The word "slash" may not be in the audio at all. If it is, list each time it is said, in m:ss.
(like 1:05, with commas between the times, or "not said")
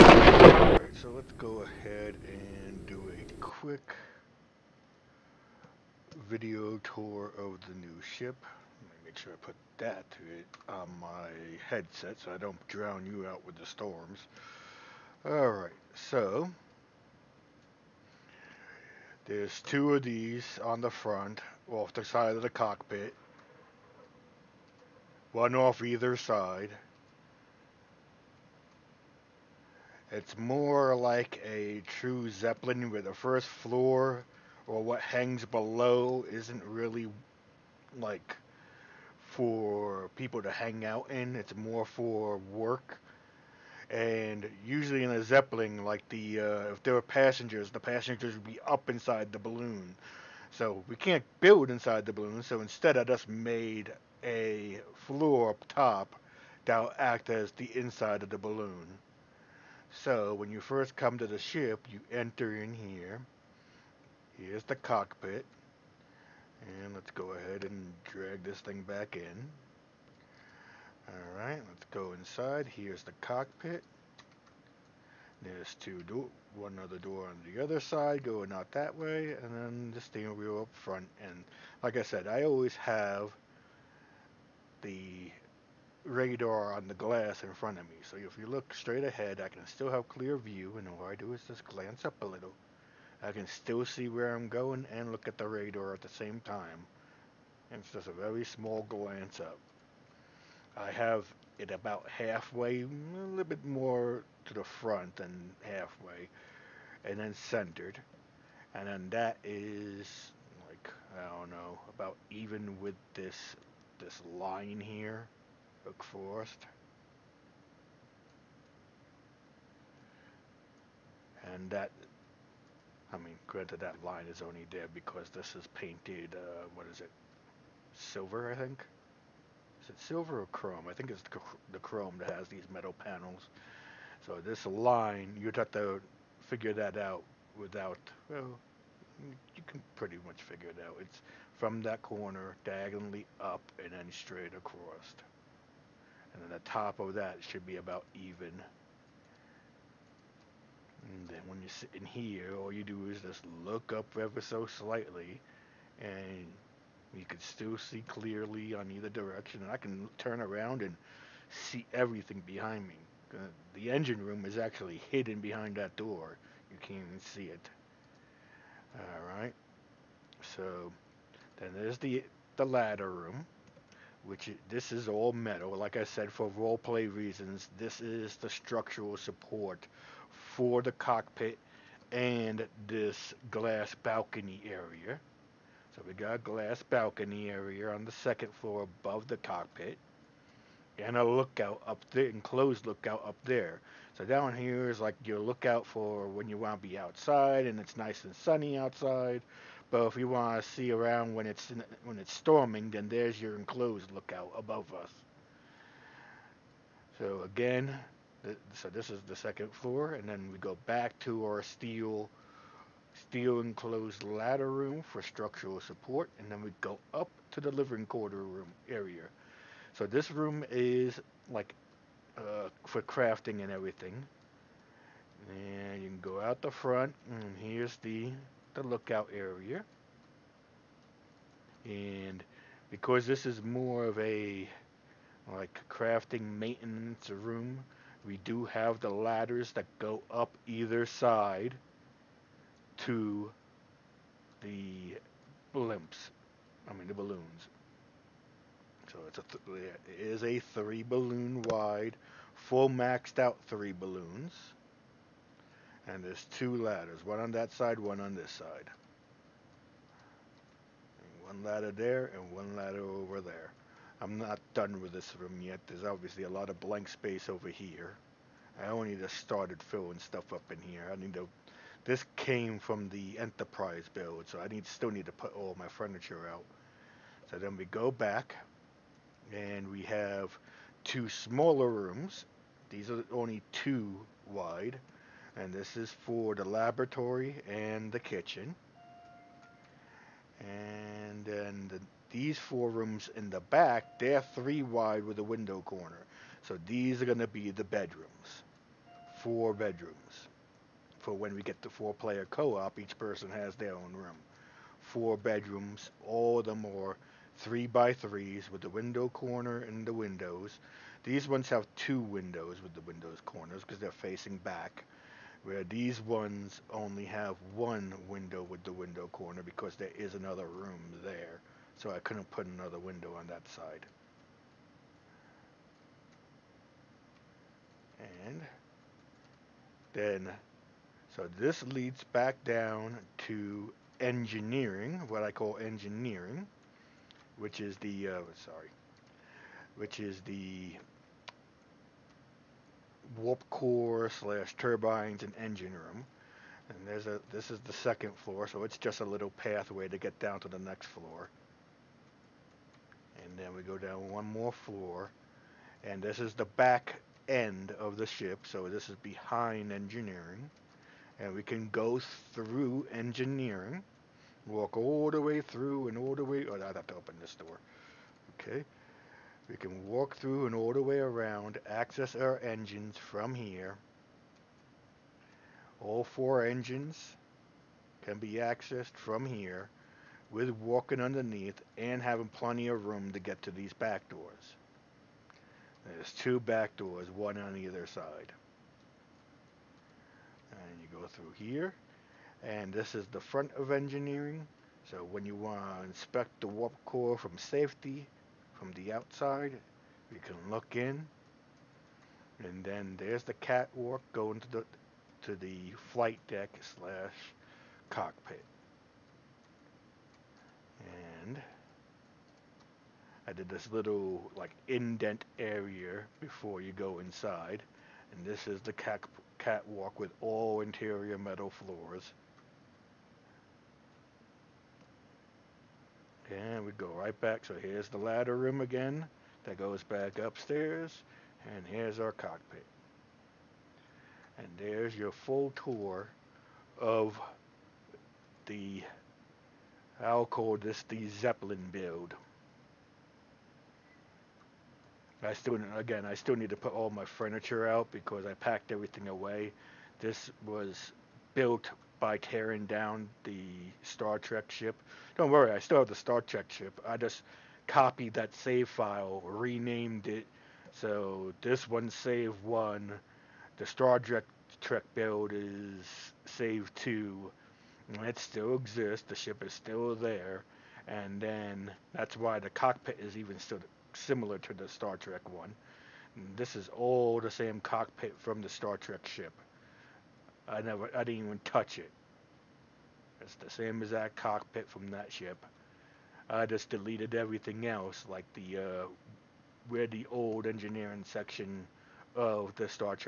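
5:44, 6:46.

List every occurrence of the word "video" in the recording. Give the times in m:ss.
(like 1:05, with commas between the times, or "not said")
0:06.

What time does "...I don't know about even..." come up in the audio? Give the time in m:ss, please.
1:51.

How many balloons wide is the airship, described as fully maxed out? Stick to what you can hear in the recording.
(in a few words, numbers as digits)
3.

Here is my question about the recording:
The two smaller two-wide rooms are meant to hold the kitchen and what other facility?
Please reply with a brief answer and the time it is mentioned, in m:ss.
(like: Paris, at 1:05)
laboratory, at 4:45.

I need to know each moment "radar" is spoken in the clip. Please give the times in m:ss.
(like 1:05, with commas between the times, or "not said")
1:26, 1:35.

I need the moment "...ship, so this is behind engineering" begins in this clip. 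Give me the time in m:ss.
5:58.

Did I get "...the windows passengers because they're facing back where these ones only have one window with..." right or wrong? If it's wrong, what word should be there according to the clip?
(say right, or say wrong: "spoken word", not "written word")
wrong: "corners", not "passengers".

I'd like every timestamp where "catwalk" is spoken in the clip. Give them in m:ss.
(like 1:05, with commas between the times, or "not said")
6:43, 6:59.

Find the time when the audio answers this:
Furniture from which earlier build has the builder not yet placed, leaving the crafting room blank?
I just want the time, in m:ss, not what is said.
4:32.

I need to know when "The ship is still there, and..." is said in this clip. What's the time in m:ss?
7:49.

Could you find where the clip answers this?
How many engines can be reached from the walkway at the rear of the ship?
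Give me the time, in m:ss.
6:15.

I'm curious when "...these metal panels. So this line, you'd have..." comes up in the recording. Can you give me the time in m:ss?
2:12.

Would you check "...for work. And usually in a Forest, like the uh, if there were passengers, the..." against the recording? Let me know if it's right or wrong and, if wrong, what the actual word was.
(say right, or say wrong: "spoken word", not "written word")
wrong: "Zeppelin", not "Forest".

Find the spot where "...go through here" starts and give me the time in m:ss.
6:31.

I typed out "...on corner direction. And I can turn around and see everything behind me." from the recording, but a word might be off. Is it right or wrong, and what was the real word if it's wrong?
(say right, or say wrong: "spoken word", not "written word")
wrong: "either", not "corner".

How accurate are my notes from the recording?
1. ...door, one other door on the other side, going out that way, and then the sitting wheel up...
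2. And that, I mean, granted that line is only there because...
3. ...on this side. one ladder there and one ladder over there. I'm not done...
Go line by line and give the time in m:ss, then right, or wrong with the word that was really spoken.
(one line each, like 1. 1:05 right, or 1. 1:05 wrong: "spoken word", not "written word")
1. 1:16 wrong: "steering", not "sitting"
2. 2:01 right
3. 4:18 right.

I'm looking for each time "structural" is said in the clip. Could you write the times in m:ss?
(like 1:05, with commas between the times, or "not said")
2:58, 3:35.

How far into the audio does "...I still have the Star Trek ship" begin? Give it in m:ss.
7:35.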